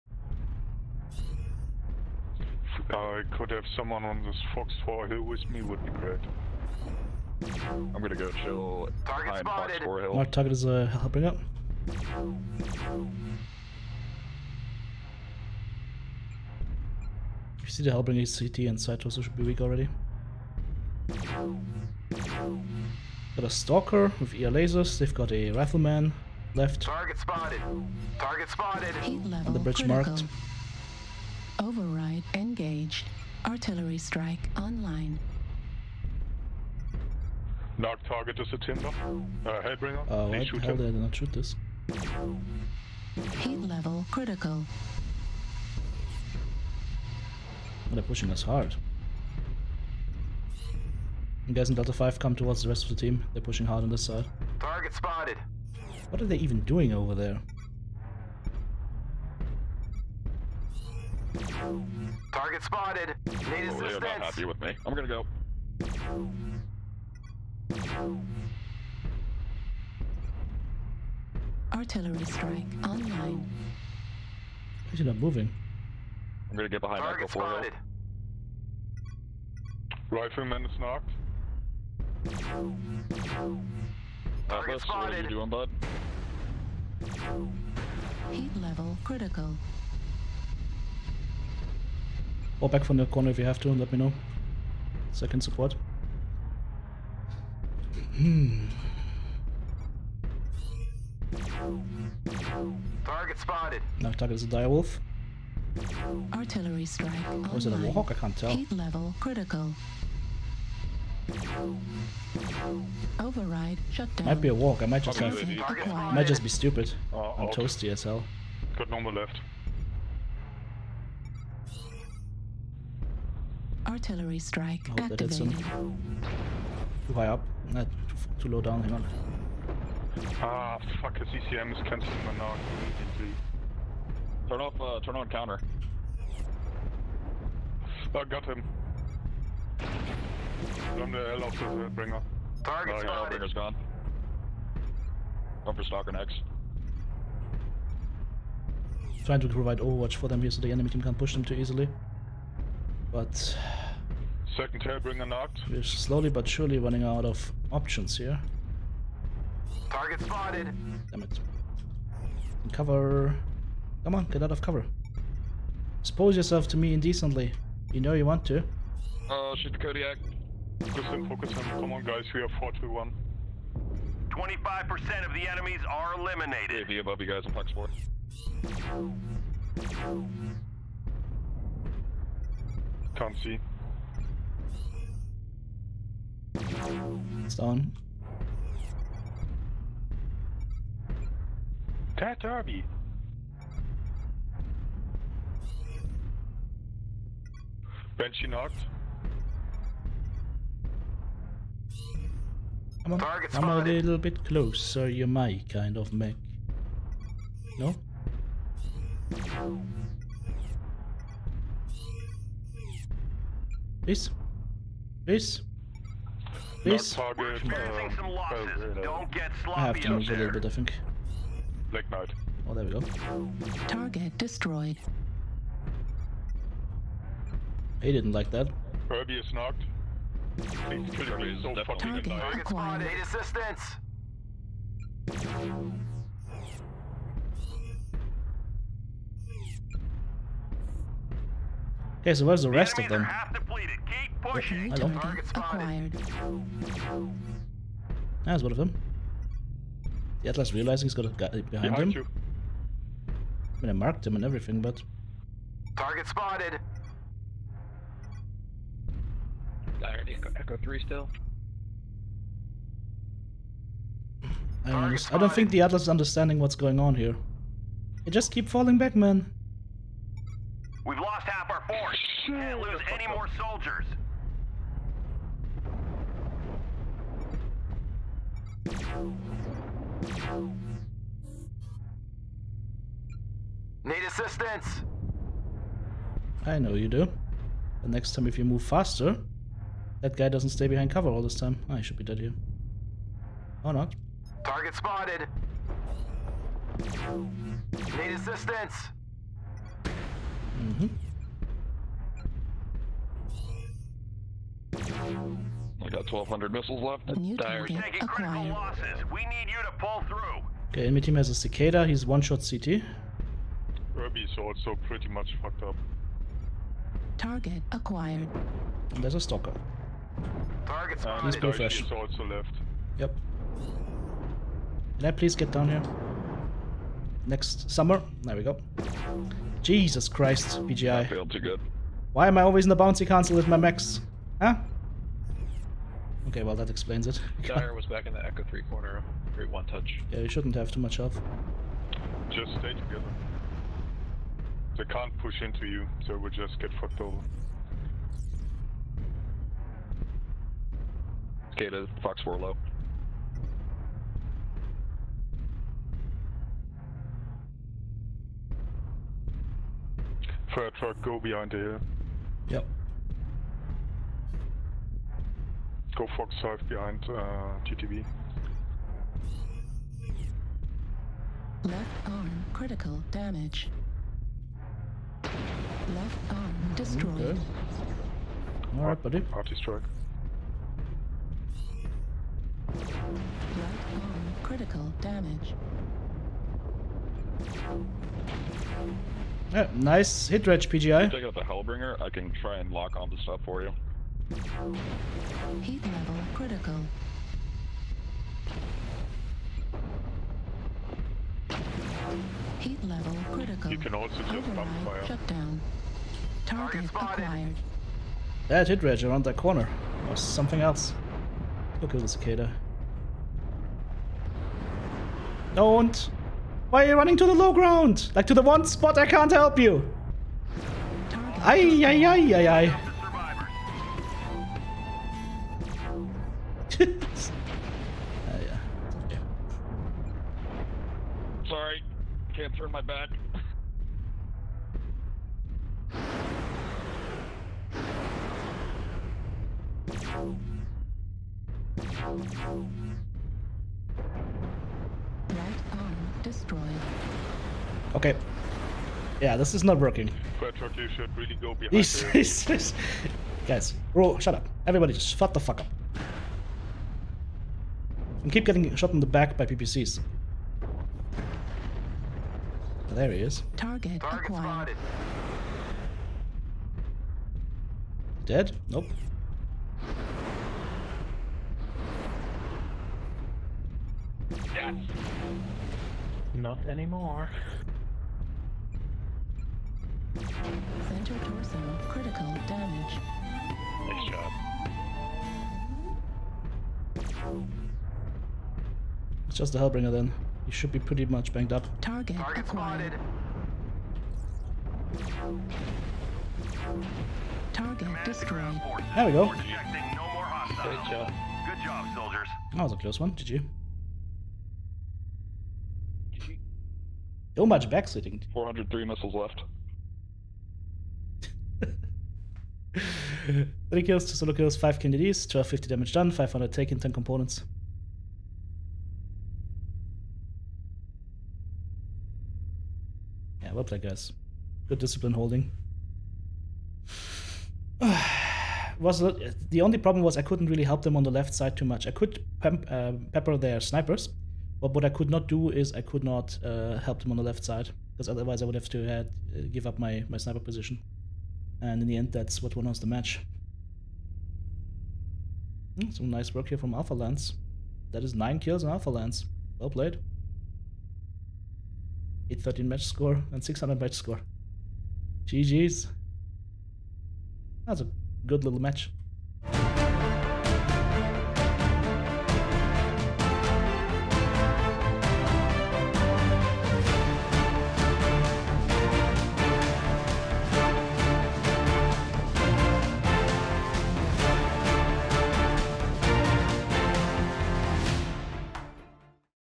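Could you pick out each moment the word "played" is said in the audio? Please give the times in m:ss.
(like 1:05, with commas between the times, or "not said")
9:09.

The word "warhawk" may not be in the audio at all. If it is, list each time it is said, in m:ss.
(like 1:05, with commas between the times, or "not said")
1:47.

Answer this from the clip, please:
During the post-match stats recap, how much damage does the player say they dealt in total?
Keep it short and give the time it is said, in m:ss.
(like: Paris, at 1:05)
1250, at 8:35.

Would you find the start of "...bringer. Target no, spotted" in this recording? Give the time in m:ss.
2:21.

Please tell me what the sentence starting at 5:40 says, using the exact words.
Yeah, you shouldn't have too much health.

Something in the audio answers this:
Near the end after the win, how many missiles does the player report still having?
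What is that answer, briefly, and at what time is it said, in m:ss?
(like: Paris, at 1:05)
403, at 8:28.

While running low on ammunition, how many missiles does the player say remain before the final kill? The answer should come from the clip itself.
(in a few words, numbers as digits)
1,200.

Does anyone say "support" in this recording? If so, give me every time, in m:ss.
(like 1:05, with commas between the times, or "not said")
1:35.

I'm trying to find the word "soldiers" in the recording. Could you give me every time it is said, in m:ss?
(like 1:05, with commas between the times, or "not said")
4:33, 8:22.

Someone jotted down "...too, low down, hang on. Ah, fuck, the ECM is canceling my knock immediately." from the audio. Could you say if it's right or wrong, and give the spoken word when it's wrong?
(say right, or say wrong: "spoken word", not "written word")
right.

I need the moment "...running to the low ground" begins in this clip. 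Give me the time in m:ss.
6:57.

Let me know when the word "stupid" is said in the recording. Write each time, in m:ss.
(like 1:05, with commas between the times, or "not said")
1:56.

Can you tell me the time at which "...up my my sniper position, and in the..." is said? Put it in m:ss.
8:59.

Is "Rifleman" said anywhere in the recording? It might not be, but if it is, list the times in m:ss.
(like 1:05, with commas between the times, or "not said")
0:25, 1:20.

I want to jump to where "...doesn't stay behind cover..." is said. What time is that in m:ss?
4:50.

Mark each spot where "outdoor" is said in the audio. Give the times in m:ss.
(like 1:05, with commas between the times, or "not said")
not said.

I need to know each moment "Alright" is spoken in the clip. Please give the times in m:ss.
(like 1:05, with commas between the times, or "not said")
6:18.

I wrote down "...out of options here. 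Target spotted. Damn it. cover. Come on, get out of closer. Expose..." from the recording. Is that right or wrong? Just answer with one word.
wrong.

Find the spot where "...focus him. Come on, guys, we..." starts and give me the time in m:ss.
2:51.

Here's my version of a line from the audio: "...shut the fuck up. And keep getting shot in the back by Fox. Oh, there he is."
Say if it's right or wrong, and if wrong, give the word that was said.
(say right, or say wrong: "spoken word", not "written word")
wrong: "PPCs", not "Fox".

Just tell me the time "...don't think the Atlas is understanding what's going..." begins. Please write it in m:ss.
4:25.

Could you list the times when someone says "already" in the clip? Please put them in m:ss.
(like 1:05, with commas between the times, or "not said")
0:19.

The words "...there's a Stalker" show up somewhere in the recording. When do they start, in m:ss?
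5:19.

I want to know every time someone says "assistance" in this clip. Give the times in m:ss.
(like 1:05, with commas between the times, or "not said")
1:03, 3:53, 4:44, 4:58.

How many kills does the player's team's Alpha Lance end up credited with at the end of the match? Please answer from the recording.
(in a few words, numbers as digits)
9.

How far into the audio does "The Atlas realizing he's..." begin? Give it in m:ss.
4:10.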